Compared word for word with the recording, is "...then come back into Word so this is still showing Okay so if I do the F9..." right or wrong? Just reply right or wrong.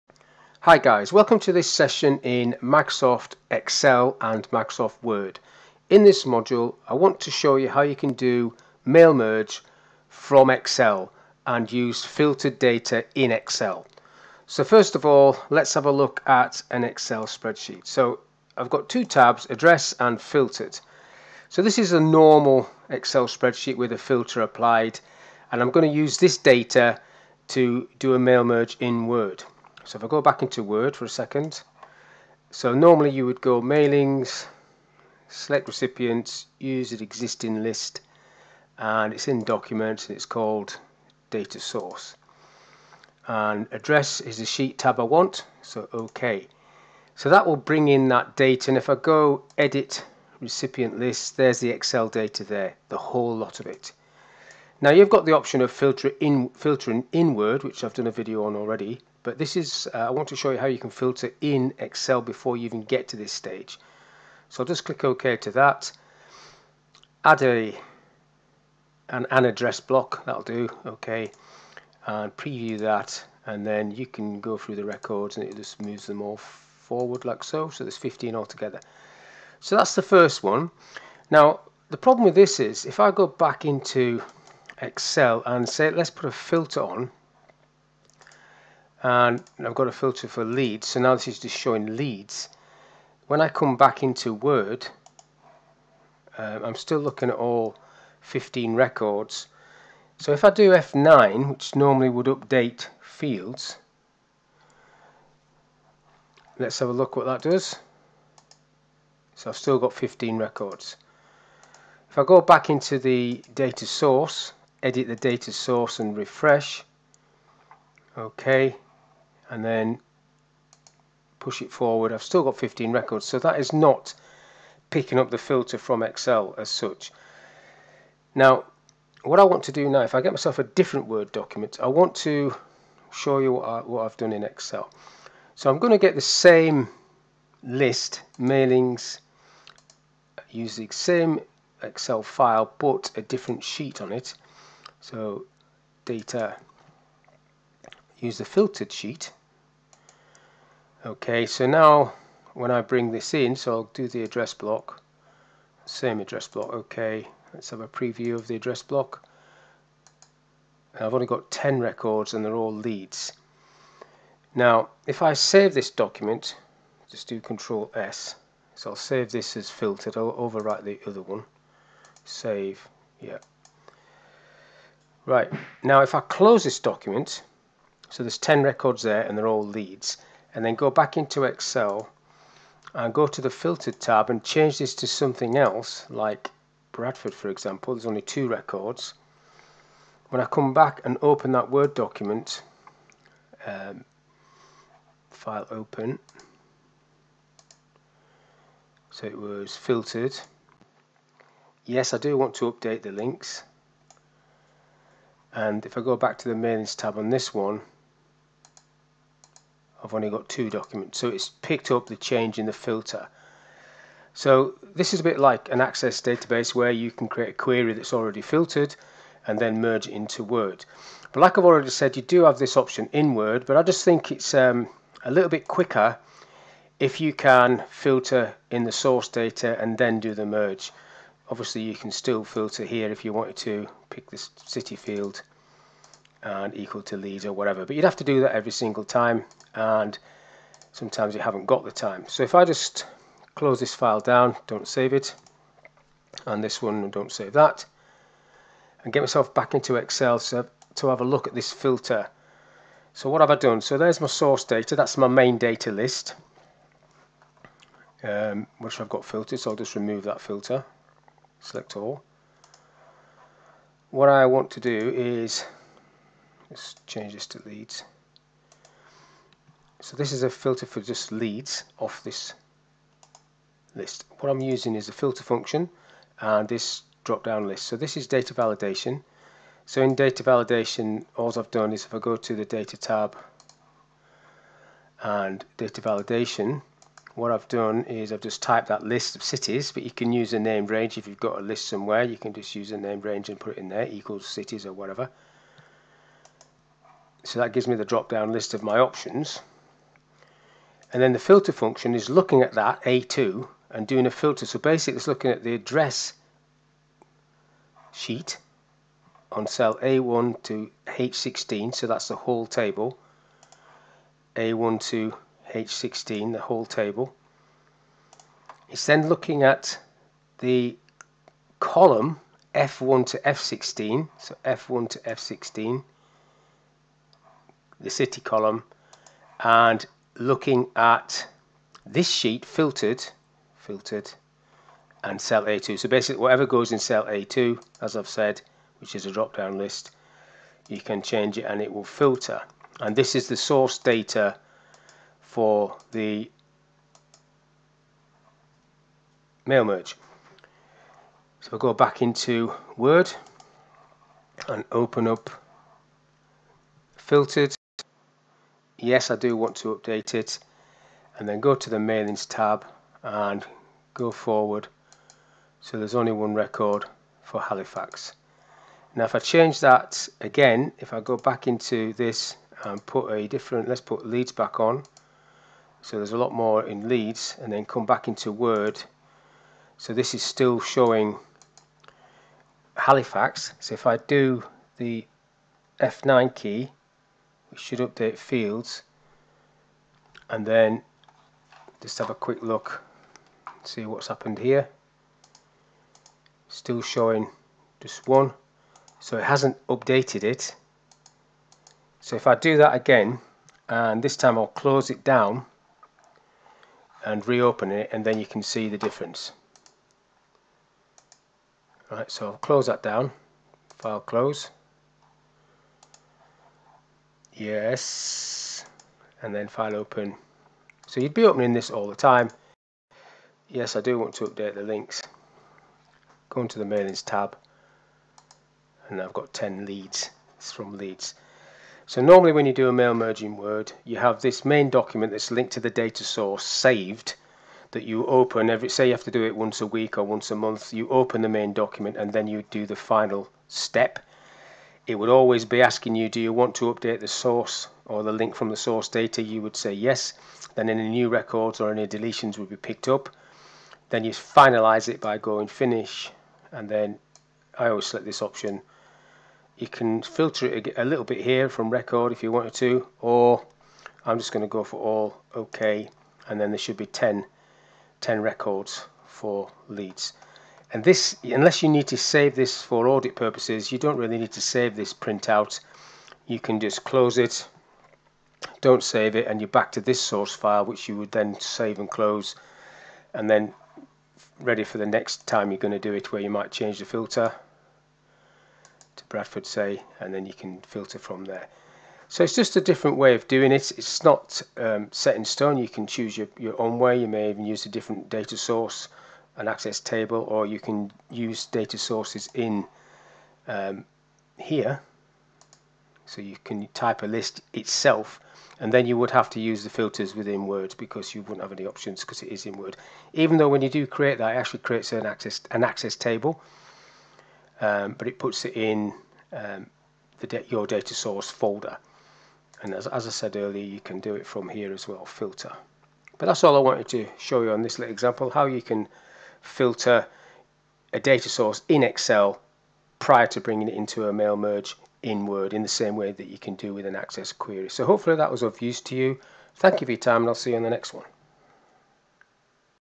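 wrong.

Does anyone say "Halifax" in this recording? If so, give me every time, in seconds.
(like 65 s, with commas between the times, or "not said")
367 s, 382 s.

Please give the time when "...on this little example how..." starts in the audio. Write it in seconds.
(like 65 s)
527 s.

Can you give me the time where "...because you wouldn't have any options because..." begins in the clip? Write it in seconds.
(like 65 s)
510 s.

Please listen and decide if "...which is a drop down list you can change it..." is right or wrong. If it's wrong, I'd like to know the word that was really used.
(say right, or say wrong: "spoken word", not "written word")
right.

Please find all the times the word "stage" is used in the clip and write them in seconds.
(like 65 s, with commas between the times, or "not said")
63 s.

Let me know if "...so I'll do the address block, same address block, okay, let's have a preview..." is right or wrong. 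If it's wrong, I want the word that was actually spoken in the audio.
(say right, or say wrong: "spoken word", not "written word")
right.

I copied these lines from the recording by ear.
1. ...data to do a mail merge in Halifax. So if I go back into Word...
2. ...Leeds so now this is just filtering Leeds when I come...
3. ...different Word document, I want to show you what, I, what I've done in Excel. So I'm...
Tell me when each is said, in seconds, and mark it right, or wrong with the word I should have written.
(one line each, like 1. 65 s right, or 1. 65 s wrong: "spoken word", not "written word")
1. 26 s wrong: "Word", not "Halifax"
2. 90 s wrong: "showing", not "filtering"
3. 130 s right.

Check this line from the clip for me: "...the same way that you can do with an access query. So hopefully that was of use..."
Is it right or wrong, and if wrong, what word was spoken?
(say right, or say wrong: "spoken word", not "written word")
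right.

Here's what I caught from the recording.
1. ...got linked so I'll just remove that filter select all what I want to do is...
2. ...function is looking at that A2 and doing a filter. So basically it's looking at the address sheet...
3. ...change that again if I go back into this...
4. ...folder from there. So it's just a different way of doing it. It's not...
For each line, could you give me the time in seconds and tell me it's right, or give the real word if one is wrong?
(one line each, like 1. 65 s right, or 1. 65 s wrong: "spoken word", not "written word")
1. 259 s wrong: "filtered", not "linked"
2. 301 s right
3. 369 s right
4. 490 s wrong: "filter", not "folder".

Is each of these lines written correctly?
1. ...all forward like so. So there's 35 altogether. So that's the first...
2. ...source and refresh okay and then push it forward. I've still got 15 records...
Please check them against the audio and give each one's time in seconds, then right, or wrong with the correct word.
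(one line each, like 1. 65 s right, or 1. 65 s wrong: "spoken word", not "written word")
1. 76 s wrong: "15", not "35"
2. 115 s right.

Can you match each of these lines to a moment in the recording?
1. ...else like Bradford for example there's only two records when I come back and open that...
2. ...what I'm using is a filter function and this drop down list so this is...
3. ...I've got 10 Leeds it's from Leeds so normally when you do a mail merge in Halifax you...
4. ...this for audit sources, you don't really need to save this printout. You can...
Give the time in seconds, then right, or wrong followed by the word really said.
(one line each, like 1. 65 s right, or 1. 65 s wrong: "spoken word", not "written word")
1. 185 s right
2. 274 s right
3. 429 s wrong: "Word", not "Halifax"
4. 472 s wrong: "purposes", not "sources".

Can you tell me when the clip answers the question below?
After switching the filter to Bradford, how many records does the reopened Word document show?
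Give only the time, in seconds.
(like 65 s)
210 s.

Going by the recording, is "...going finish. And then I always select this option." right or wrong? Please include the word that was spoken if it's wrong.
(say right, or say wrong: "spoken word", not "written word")
right.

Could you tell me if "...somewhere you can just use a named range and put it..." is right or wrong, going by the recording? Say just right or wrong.
right.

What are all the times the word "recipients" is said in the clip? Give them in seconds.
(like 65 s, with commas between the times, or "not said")
35 s, 50 s.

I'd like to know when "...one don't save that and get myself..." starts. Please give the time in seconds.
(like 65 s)
246 s.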